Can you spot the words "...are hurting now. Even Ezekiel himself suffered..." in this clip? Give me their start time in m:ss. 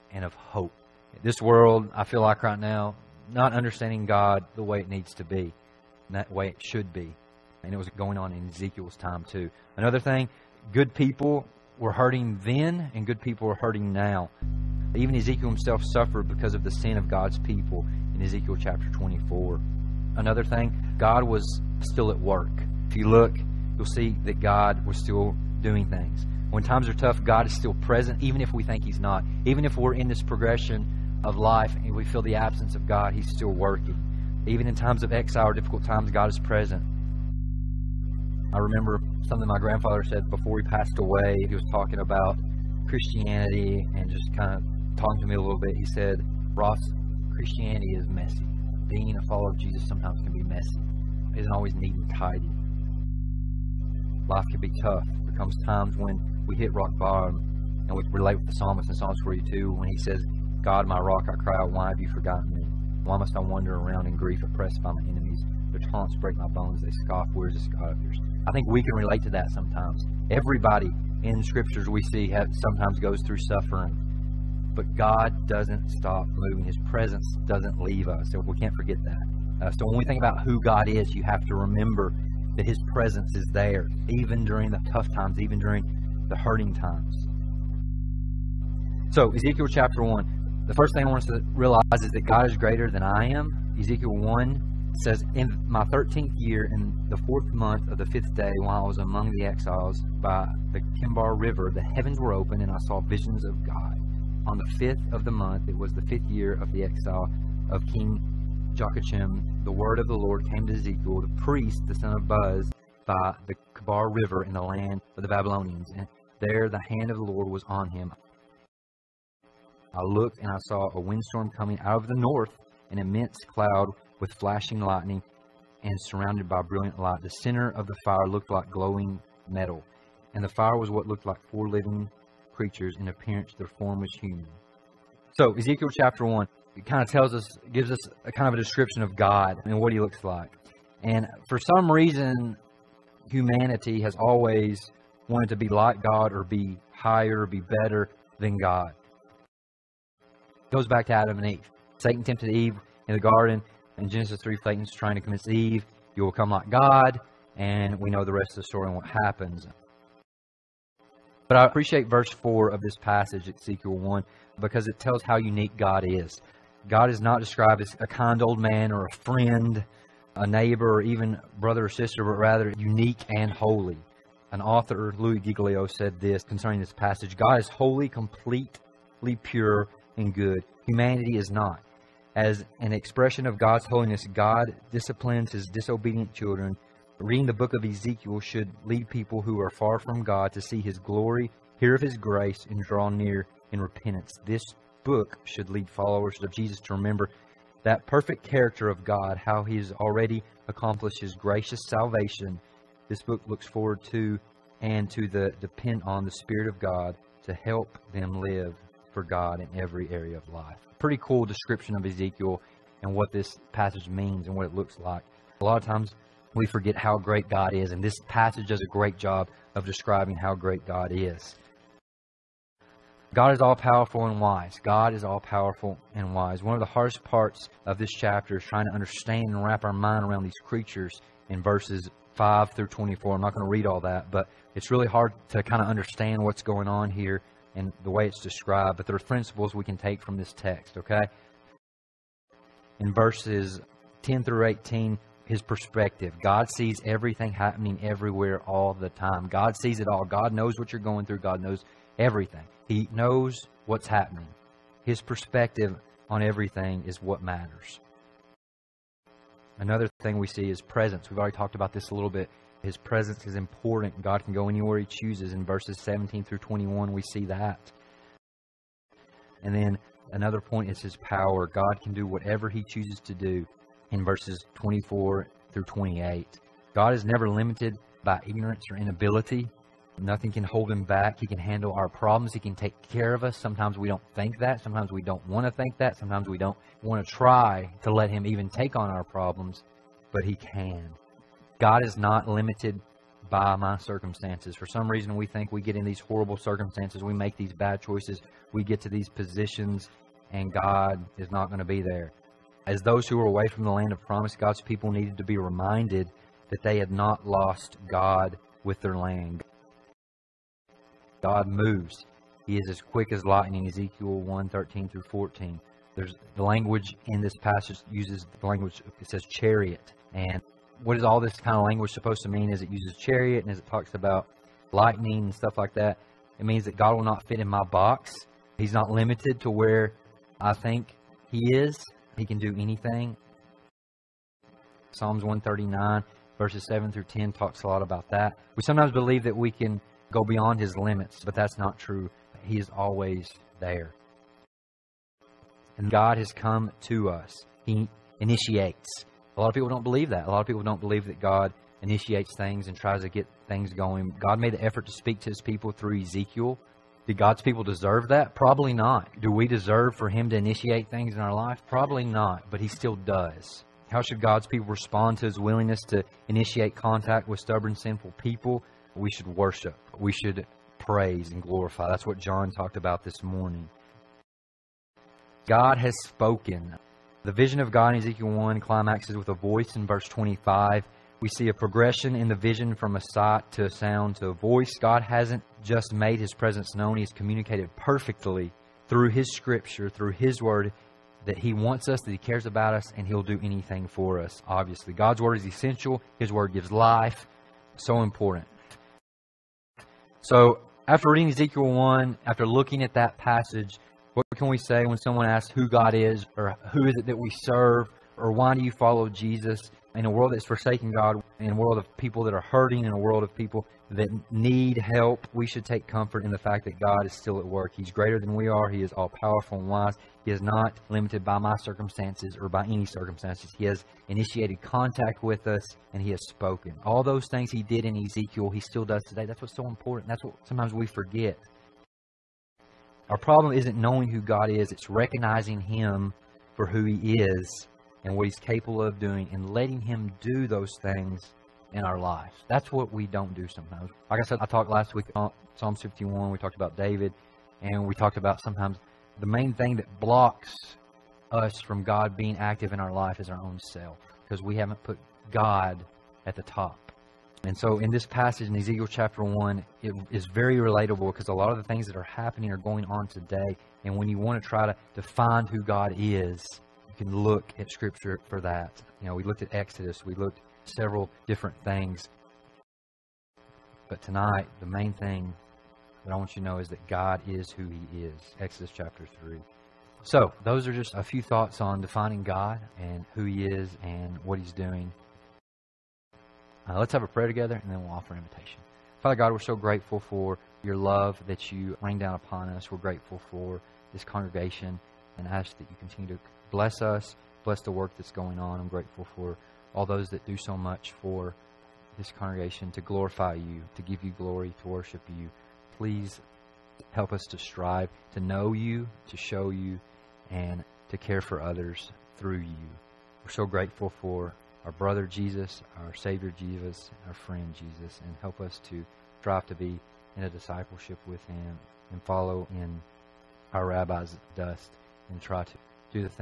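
0:13.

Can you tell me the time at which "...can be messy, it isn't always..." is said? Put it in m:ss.
0:50.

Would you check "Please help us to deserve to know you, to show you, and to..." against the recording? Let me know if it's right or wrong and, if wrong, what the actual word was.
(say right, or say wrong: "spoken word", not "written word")
wrong: "strive", not "deserve".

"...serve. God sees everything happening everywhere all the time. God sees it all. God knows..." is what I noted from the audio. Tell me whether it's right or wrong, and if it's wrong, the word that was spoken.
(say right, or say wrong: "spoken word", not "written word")
wrong: "perspective", not "serve".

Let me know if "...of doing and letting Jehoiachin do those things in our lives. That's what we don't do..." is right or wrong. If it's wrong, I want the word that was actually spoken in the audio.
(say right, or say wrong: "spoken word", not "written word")
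wrong: "Him", not "Jehoiachin".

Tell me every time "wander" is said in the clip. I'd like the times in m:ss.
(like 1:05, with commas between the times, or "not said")
1:03.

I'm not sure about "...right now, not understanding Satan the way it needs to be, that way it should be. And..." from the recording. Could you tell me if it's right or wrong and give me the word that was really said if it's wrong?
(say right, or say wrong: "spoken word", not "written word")
wrong: "God", not "Satan".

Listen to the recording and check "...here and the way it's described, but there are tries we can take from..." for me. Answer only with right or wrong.
wrong.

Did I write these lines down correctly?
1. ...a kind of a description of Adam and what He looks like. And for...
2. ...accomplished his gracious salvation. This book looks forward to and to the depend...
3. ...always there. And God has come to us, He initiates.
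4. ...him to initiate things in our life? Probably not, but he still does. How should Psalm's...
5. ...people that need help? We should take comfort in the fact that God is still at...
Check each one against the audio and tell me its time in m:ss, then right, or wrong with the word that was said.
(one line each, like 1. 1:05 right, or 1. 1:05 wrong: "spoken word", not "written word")
1. 2:18 wrong: "God", not "Adam"
2. 3:20 right
3. 5:42 right
4. 6:00 wrong: "God", not "Psalm"
5. 6:53 right.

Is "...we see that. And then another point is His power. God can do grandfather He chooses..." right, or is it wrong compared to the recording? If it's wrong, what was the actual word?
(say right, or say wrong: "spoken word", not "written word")
wrong: "whatever", not "grandfather".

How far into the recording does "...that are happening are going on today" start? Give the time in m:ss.
7:42.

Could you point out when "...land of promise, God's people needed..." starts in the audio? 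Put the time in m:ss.
5:03.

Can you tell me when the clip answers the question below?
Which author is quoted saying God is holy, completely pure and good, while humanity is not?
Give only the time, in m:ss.
2:55.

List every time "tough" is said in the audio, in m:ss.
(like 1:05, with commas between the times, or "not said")
0:26, 0:54, 1:24.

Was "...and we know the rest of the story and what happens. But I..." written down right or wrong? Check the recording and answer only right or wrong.
right.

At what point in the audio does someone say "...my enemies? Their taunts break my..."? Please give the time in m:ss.
1:04.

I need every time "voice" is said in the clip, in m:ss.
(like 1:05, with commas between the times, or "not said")
6:19, 6:24.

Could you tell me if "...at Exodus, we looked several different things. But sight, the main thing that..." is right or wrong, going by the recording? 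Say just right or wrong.
wrong.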